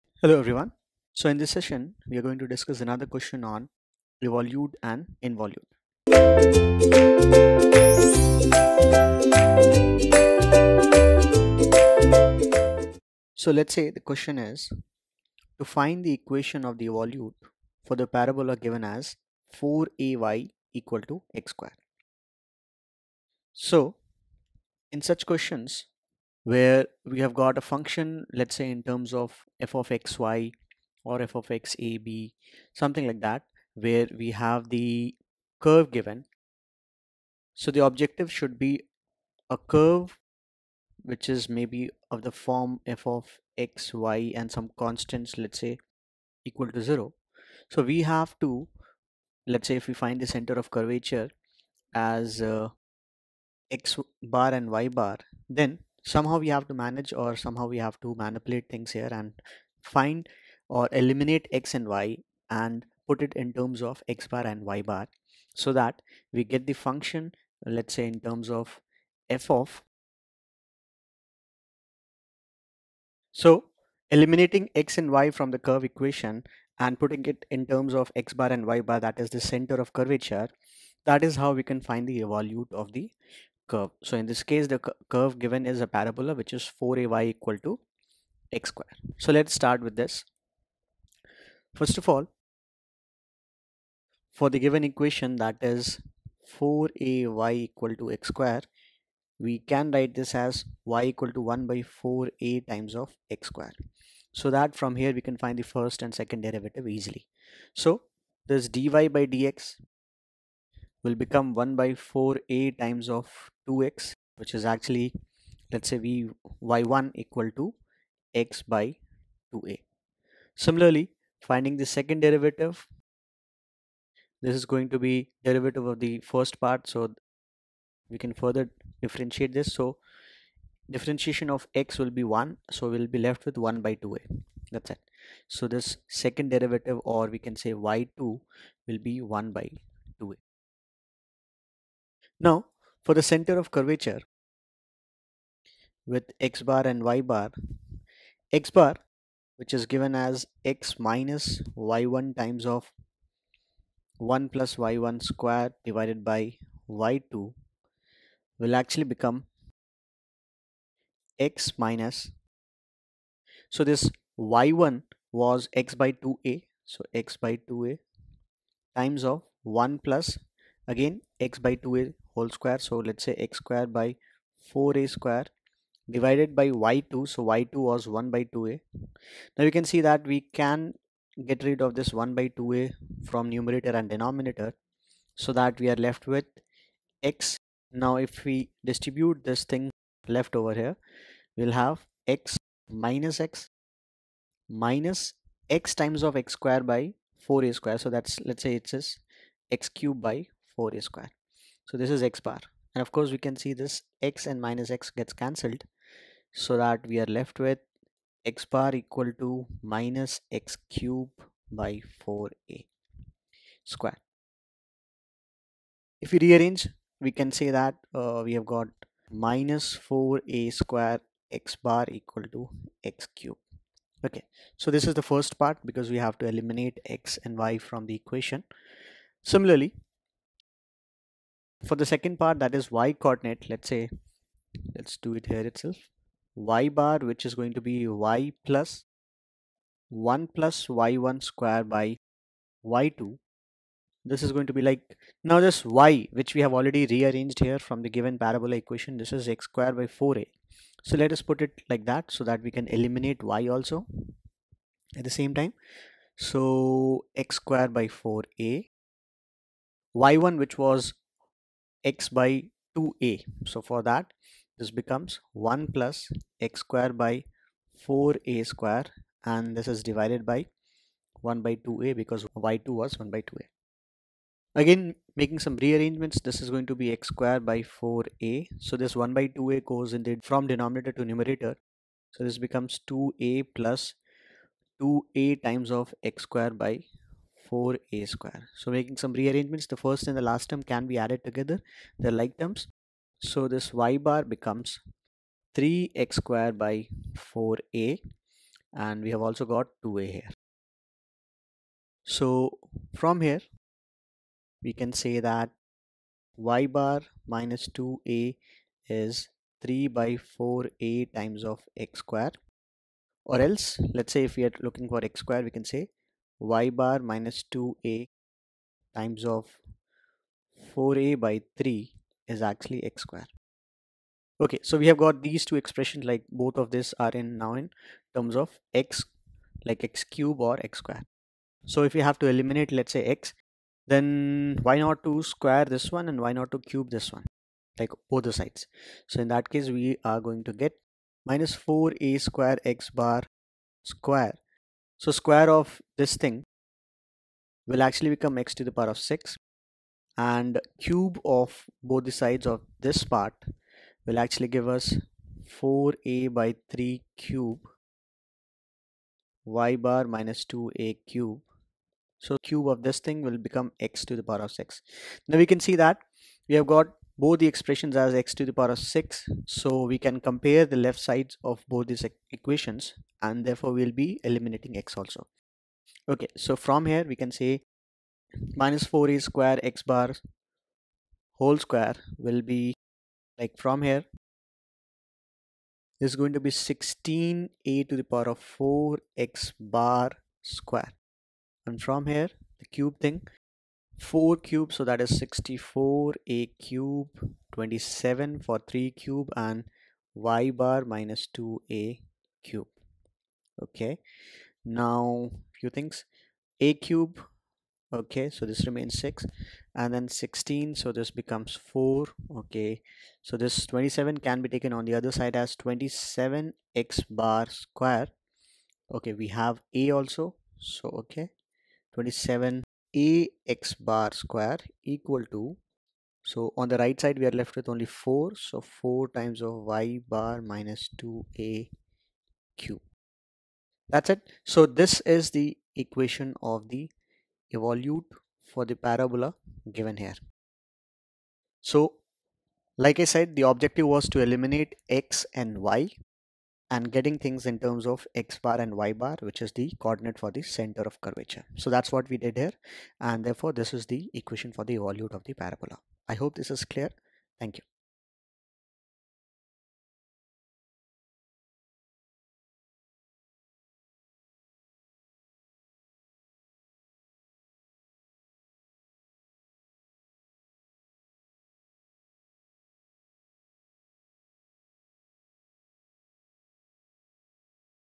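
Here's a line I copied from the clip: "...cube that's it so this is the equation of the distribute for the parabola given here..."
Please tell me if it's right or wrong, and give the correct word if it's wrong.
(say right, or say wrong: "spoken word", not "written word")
wrong: "evolute", not "distribute".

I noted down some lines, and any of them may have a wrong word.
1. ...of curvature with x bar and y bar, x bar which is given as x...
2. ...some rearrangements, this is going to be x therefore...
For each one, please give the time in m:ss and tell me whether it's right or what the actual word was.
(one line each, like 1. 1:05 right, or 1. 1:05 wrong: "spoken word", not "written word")
1. 2:23 right
2. 4:35 wrong: "square", not "therefore".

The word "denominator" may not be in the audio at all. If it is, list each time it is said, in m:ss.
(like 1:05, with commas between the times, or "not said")
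3:04, 4:40.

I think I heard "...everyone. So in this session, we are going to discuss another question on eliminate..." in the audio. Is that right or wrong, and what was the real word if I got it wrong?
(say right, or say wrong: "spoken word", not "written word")
wrong: "evolute", not "eliminate".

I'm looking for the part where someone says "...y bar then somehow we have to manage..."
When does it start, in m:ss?
0:54.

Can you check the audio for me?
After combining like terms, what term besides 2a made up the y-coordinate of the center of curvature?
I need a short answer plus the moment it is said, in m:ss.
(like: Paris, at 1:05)
3x^2/4a, at 4:55.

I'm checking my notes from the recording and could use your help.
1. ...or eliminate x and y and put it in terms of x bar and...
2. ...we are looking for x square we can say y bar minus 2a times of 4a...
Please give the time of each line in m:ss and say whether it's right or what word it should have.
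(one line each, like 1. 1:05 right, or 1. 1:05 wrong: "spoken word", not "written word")
1. 1:00 right
2. 5:14 right.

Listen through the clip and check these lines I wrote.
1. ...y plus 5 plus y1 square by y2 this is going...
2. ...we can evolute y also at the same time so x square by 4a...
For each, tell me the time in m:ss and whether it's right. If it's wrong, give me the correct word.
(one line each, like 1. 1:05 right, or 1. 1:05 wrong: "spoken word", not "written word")
1. 3:58 wrong: "1", not "5"
2. 4:12 wrong: "eliminate", not "evolute".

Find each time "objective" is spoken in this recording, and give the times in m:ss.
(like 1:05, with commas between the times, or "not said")
0:37, 7:23.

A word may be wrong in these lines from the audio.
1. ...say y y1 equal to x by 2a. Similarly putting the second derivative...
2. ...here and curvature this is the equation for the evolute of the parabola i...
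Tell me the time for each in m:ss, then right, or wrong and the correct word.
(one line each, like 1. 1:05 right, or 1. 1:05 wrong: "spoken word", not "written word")
1. 1:55 wrong: "finding", not "putting"
2. 7:32 wrong: "therefore", not "curvature".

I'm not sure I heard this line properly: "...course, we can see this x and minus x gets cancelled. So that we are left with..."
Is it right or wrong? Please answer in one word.
right.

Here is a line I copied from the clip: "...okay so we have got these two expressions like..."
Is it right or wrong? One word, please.
right.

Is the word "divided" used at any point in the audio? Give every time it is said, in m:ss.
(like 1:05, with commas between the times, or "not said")
2:35, 2:56, 4:30.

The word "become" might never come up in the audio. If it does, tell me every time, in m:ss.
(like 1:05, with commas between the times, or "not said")
1:51, 2:39, 4:24, 4:42, 4:54, 5:48, 6:03, 6:51.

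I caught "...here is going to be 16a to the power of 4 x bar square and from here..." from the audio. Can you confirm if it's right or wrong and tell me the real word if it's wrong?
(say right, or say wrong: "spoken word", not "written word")
right.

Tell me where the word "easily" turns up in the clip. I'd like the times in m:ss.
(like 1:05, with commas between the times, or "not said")
1:46.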